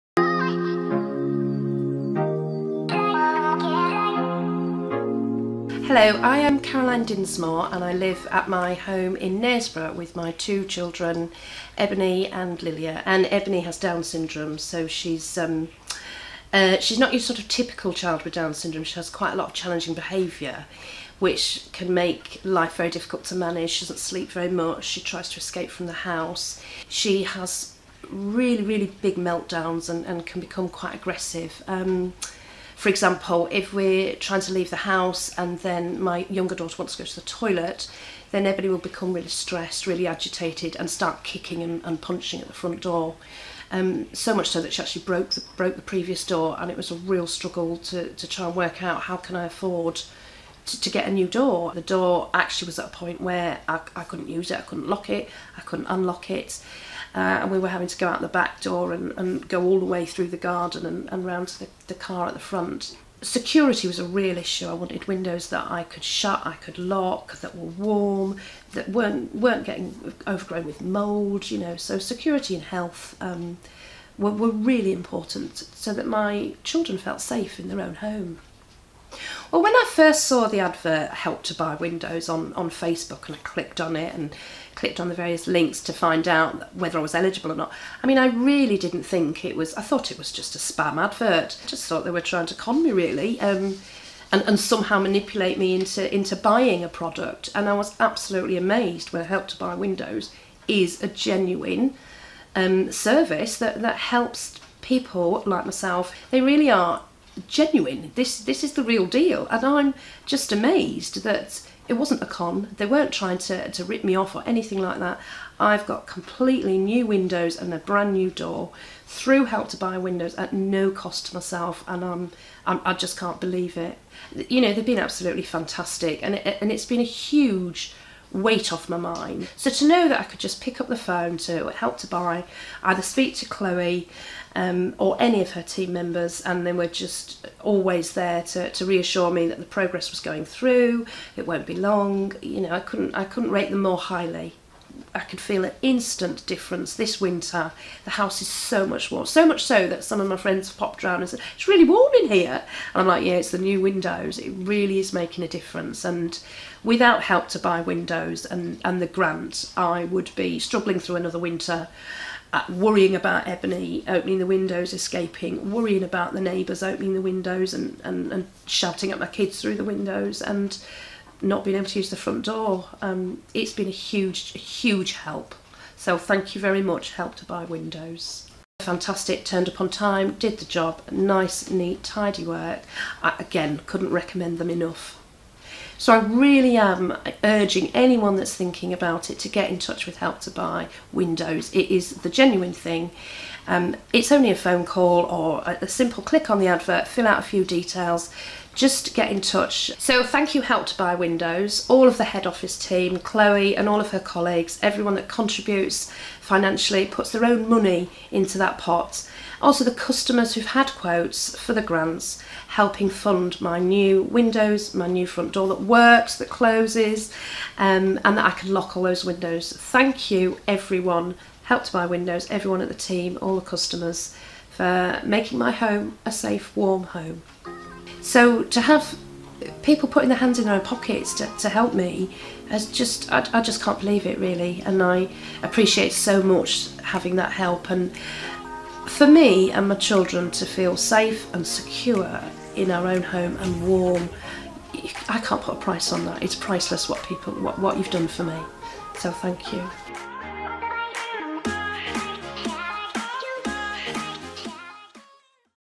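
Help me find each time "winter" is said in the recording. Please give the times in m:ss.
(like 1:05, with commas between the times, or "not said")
2:27, 2:41.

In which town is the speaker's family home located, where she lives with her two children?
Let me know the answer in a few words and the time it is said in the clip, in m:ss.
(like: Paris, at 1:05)
Knaresborough, at 0:09.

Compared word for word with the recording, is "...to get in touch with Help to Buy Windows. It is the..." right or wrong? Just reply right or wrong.
right.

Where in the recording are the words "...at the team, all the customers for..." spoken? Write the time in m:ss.
3:42.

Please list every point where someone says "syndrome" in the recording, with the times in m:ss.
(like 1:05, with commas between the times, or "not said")
0:14, 0:18.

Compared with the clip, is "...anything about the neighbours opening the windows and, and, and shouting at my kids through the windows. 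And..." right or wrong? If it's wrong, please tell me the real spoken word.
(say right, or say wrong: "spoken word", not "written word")
wrong: "worrying", not "anything".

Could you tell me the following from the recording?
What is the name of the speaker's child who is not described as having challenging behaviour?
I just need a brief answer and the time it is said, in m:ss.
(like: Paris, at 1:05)
Lilia, at 0:12.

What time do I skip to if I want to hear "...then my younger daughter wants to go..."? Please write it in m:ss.
0:35.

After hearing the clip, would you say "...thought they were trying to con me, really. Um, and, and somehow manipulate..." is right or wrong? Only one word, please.
right.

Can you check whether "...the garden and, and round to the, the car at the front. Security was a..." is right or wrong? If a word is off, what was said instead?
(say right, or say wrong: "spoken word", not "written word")
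right.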